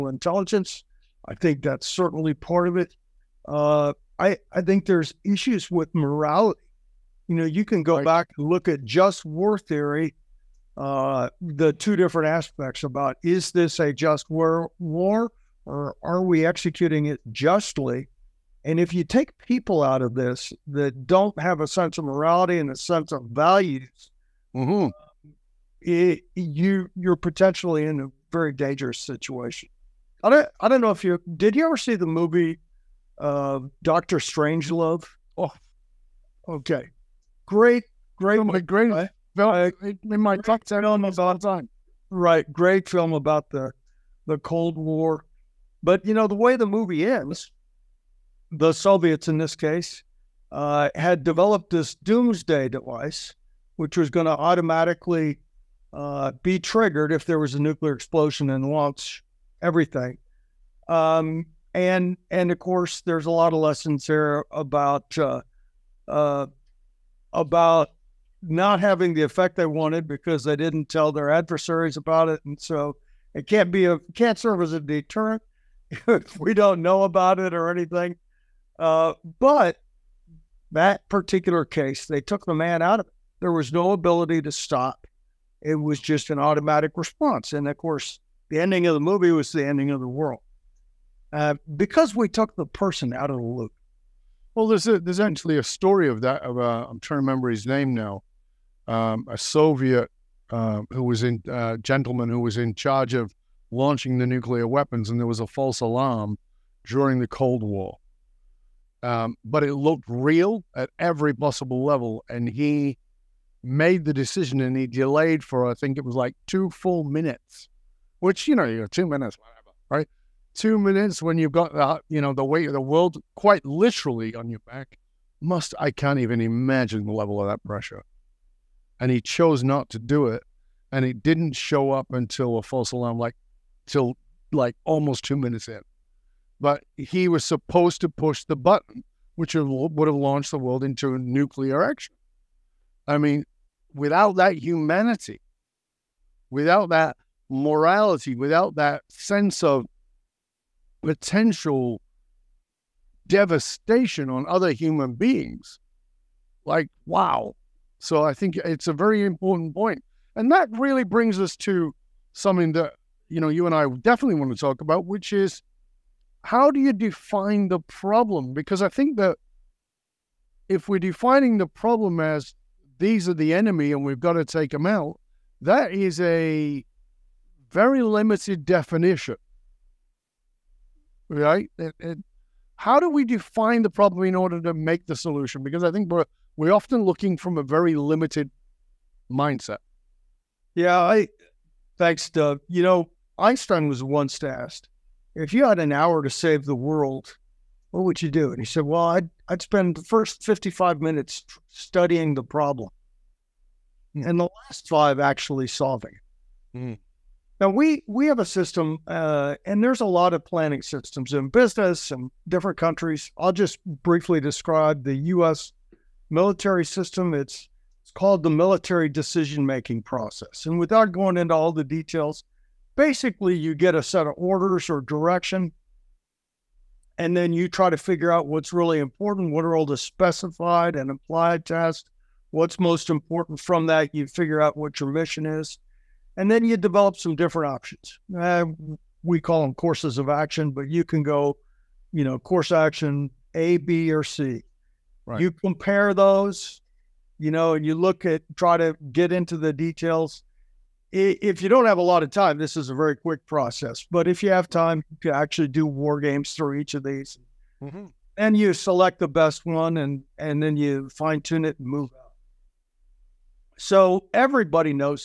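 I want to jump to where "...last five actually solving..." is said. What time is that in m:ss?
3:24.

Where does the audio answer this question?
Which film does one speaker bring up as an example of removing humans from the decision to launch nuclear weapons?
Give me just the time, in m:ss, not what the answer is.
0:33.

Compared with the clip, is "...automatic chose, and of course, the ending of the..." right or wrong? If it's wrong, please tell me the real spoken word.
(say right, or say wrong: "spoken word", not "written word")
wrong: "response", not "chose".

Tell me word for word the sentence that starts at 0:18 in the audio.
And if you take people out of this that don't have a sense of morality and a sense of values, mm-hmm.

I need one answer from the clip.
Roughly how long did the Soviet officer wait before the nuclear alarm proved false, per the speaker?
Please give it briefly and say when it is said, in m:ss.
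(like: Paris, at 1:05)
2 minutes, at 1:56.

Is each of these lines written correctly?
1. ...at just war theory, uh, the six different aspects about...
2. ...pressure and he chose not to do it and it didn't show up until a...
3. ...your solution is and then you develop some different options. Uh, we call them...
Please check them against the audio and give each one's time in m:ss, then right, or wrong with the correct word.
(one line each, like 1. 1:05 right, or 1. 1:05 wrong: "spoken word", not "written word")
1. 0:08 wrong: "two", not "six"
2. 2:07 right
3. 3:55 wrong: "mission", not "solution".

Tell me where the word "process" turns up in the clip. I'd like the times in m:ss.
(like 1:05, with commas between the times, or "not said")
3:40, 4:13.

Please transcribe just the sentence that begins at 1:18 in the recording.
Uh, but that particular case, they took the man out of it.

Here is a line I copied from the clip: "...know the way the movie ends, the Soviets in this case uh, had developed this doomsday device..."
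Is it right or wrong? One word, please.
right.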